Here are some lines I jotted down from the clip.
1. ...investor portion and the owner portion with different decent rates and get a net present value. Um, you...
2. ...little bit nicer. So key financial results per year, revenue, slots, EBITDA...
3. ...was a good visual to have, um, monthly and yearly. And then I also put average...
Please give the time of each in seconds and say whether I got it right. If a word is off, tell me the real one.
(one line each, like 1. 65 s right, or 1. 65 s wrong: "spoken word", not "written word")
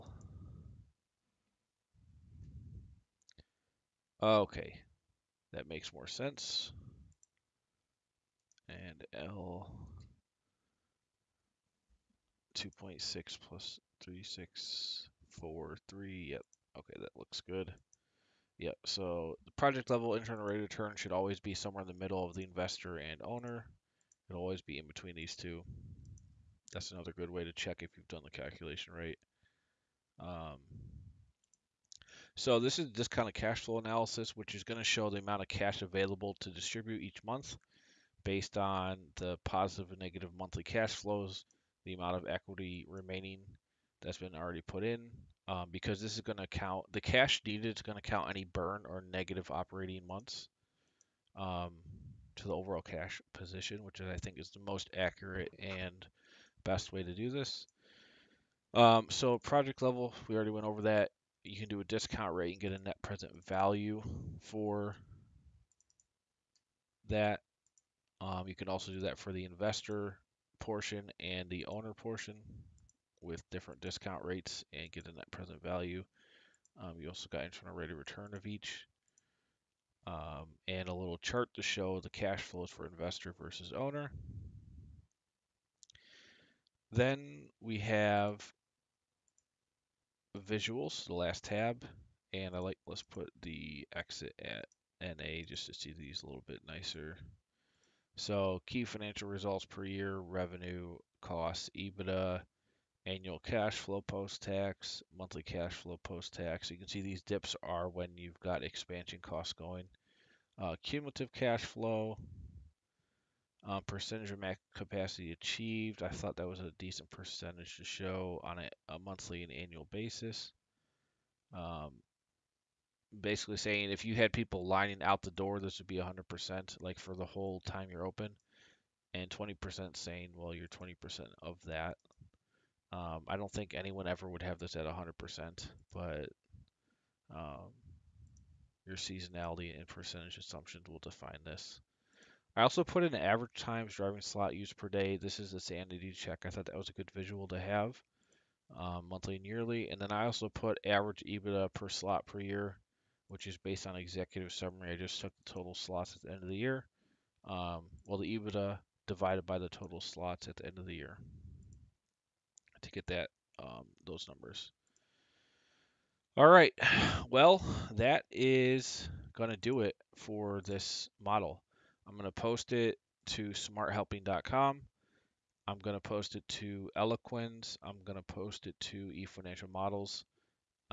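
1. 69 s wrong: "discount", not "decent"
2. 96 s wrong: "costs", not "slots"
3. 146 s right.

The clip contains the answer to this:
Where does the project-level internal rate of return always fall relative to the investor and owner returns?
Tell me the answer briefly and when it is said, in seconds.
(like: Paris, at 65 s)
In the middle, at 21 s.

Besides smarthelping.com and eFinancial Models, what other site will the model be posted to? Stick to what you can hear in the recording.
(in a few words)
Eloquens.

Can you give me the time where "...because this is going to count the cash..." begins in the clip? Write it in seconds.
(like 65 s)
45 s.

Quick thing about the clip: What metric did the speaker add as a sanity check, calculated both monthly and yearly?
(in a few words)
Average times driving slot used per day.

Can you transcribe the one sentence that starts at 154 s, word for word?
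I just took the total slots at the end of the year.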